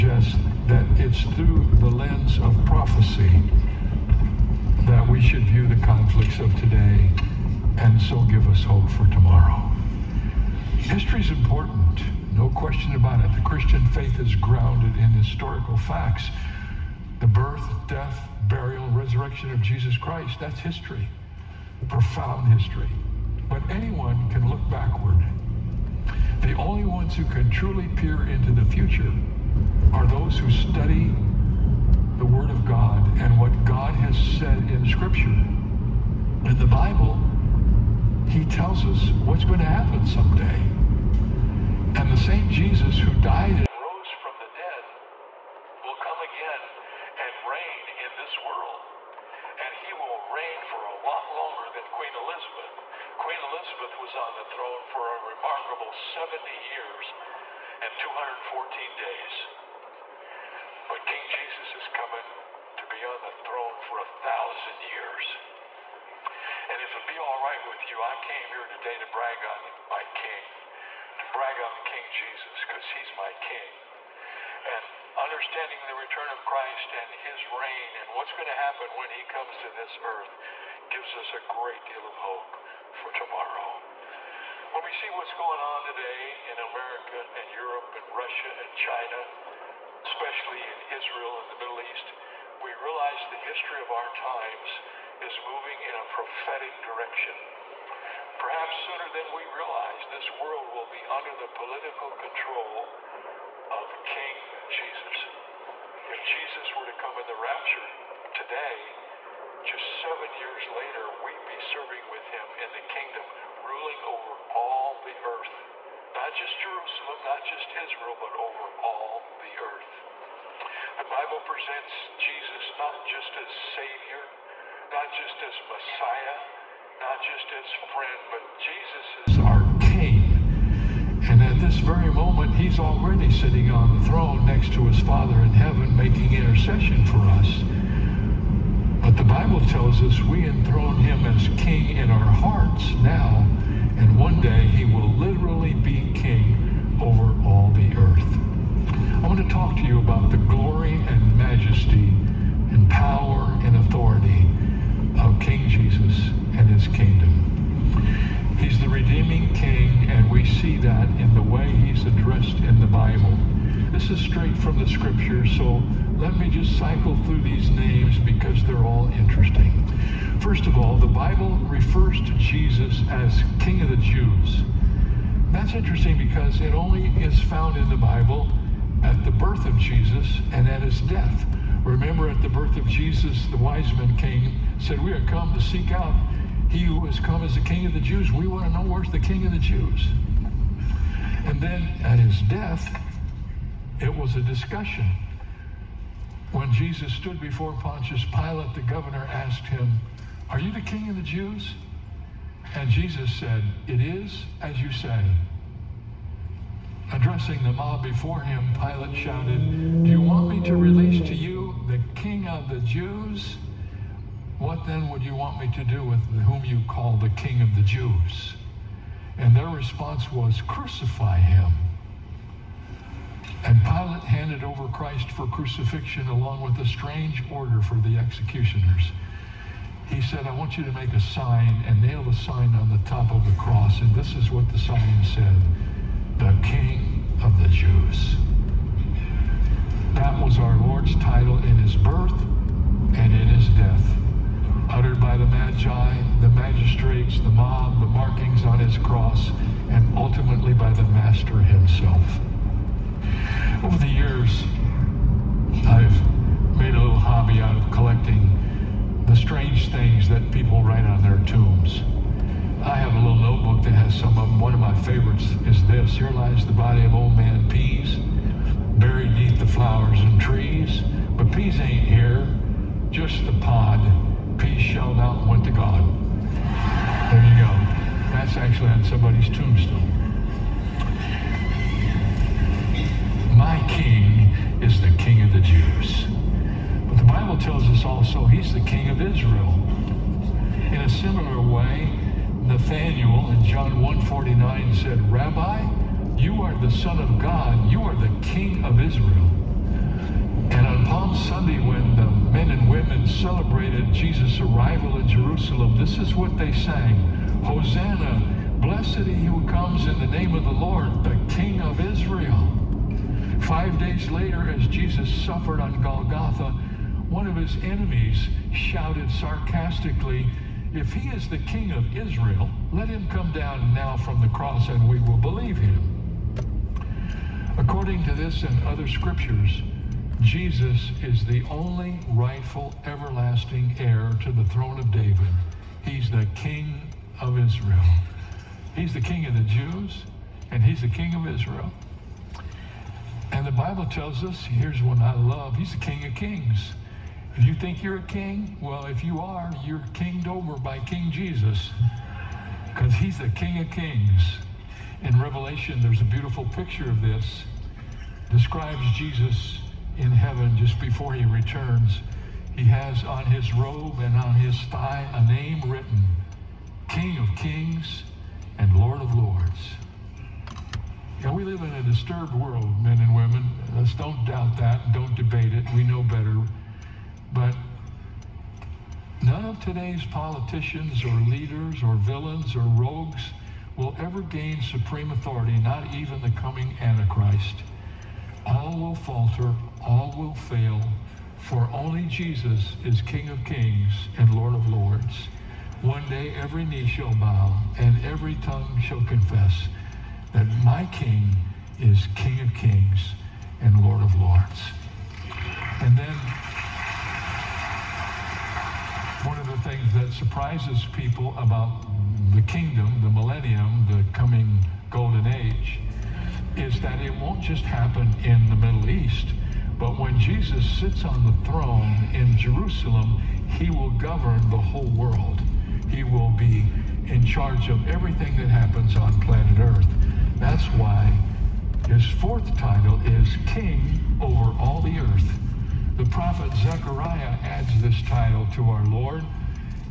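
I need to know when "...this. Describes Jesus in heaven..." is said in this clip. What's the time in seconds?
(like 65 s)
357 s.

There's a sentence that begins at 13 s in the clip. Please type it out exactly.
The Christian faith is grounded in historical facts.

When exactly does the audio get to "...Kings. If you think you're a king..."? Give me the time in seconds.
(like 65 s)
346 s.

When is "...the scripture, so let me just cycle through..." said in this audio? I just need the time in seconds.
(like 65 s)
164 s.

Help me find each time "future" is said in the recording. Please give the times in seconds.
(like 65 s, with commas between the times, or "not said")
28 s.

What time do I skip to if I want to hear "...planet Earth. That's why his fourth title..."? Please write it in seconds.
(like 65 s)
429 s.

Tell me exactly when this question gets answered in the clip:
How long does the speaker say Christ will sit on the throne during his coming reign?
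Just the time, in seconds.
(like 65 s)
63 s.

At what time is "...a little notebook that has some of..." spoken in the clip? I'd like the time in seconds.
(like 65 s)
263 s.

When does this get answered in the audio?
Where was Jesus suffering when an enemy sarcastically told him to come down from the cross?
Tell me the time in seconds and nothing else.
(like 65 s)
316 s.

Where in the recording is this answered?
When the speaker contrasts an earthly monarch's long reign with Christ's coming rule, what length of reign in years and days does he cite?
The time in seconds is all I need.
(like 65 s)
55 s.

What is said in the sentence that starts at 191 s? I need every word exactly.
And then at his death, it was a discussion.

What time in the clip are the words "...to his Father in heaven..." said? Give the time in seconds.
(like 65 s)
134 s.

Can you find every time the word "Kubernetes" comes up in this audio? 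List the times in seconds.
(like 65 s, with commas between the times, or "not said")
not said.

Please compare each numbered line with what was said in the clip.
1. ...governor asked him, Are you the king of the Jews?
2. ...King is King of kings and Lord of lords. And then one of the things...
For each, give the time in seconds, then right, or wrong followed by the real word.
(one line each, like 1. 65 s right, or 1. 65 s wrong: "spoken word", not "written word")
1. 198 s right
2. 401 s right.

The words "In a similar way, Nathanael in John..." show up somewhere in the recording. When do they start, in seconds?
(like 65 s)
290 s.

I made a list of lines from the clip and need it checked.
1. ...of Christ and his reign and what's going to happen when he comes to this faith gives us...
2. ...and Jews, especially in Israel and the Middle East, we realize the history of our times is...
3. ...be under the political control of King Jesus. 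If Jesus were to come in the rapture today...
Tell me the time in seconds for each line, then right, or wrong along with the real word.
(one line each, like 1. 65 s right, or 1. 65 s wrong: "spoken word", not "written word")
1. 76 s wrong: "earth", not "faith"
2. 88 s wrong: "China", not "Jews"
3. 100 s right.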